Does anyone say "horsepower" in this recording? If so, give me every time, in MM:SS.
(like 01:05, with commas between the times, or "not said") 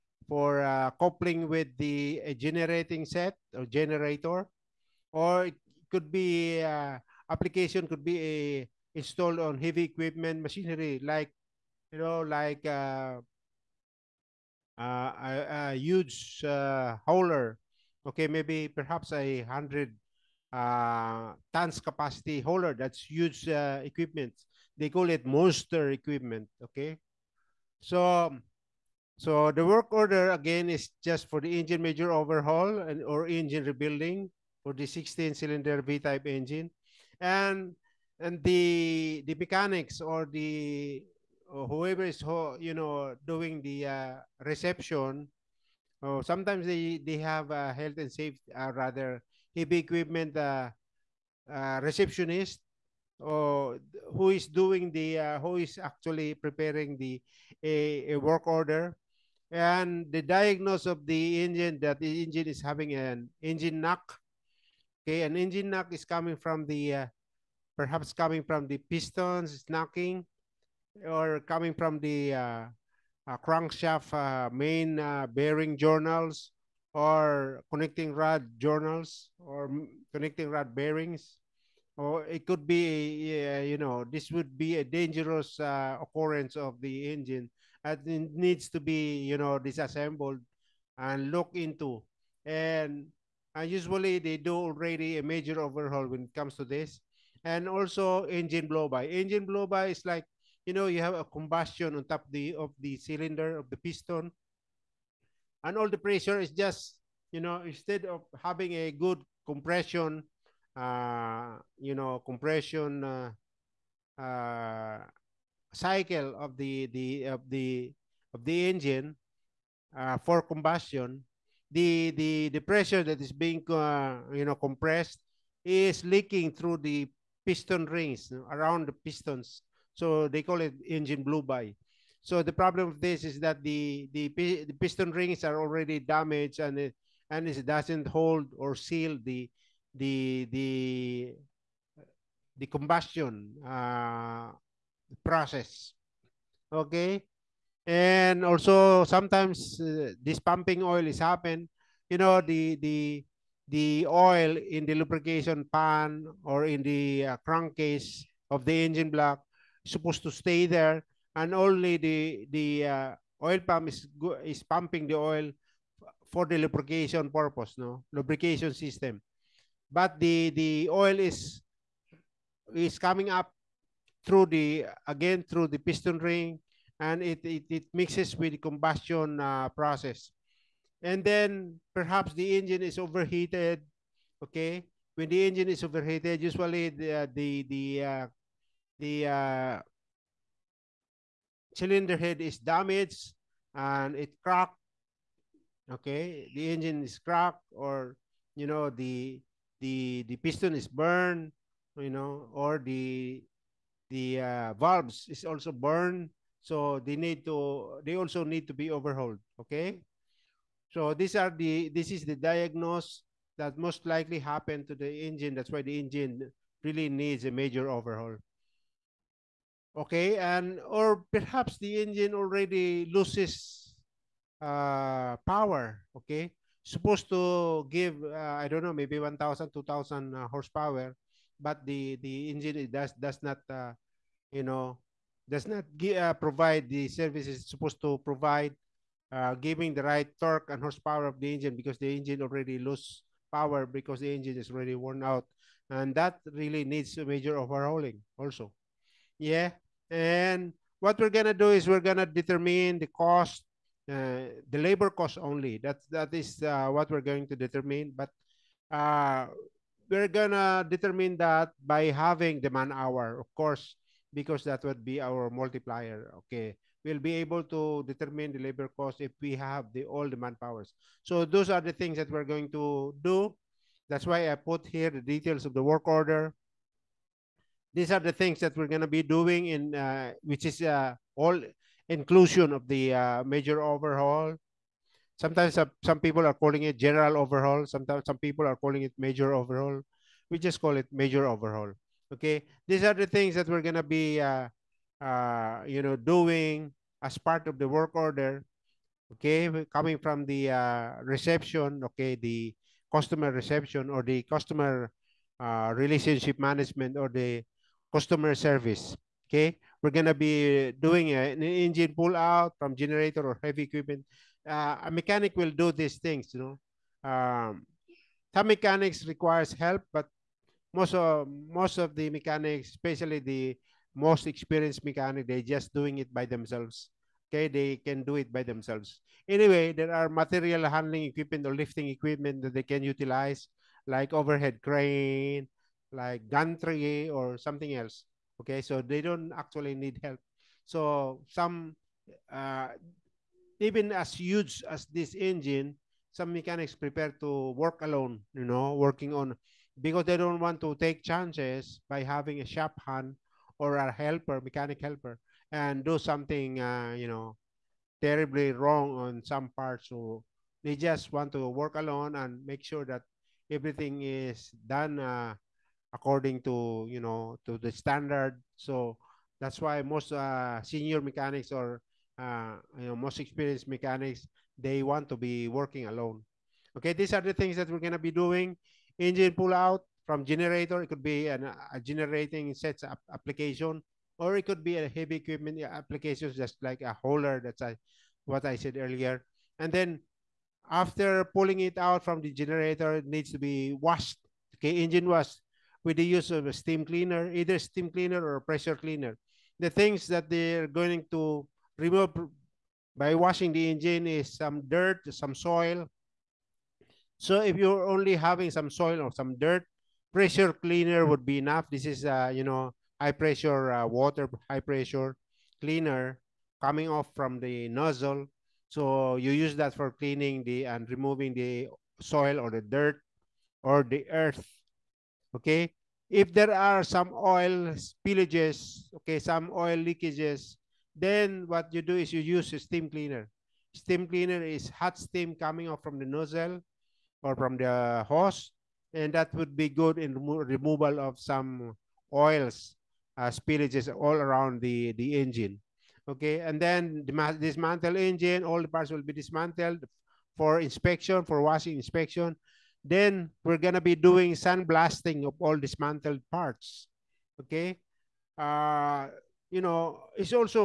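03:50, 04:00.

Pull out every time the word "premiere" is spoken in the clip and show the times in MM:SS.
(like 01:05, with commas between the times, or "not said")
not said.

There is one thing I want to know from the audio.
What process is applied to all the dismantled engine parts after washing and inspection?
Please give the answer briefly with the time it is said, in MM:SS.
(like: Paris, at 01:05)
sandblasting, at 07:34.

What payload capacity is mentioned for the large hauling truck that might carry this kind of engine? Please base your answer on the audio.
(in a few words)
100 tons.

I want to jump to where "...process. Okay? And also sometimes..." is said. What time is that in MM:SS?
02:25.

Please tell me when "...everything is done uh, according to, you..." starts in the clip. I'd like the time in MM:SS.
06:03.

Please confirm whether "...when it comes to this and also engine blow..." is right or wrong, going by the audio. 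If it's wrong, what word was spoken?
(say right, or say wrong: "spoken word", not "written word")
right.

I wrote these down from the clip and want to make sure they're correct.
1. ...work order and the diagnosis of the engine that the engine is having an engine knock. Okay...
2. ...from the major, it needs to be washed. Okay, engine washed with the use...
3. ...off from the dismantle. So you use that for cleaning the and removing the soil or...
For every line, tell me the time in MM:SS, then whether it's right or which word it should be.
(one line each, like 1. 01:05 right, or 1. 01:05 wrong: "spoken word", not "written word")
1. 00:58 right
2. 06:32 wrong: "generator", not "major"
3. 06:57 wrong: "nozzle", not "dismantle".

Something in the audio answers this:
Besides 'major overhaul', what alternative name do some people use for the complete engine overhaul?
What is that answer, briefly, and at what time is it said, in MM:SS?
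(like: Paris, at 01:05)
general overhaul, at 04:46.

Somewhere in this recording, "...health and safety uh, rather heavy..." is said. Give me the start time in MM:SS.
00:47.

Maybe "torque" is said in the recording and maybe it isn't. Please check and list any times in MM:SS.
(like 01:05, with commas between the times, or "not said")
04:00.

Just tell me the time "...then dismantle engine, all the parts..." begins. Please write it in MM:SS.
07:26.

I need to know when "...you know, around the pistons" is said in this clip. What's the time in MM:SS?
02:08.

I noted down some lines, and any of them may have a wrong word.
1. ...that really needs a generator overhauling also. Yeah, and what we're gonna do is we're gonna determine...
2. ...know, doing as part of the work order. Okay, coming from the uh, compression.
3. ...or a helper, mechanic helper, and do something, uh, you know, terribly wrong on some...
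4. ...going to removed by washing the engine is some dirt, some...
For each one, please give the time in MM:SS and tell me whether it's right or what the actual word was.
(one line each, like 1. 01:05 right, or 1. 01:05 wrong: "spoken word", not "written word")
1. 04:06 wrong: "major", not "generator"
2. 04:56 wrong: "reception", not "compression"
3. 05:53 right
4. 06:40 right.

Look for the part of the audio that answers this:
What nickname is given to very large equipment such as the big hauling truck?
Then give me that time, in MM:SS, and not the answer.
00:25.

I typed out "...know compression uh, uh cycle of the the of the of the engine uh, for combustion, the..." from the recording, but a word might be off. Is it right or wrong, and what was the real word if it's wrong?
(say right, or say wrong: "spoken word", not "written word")
right.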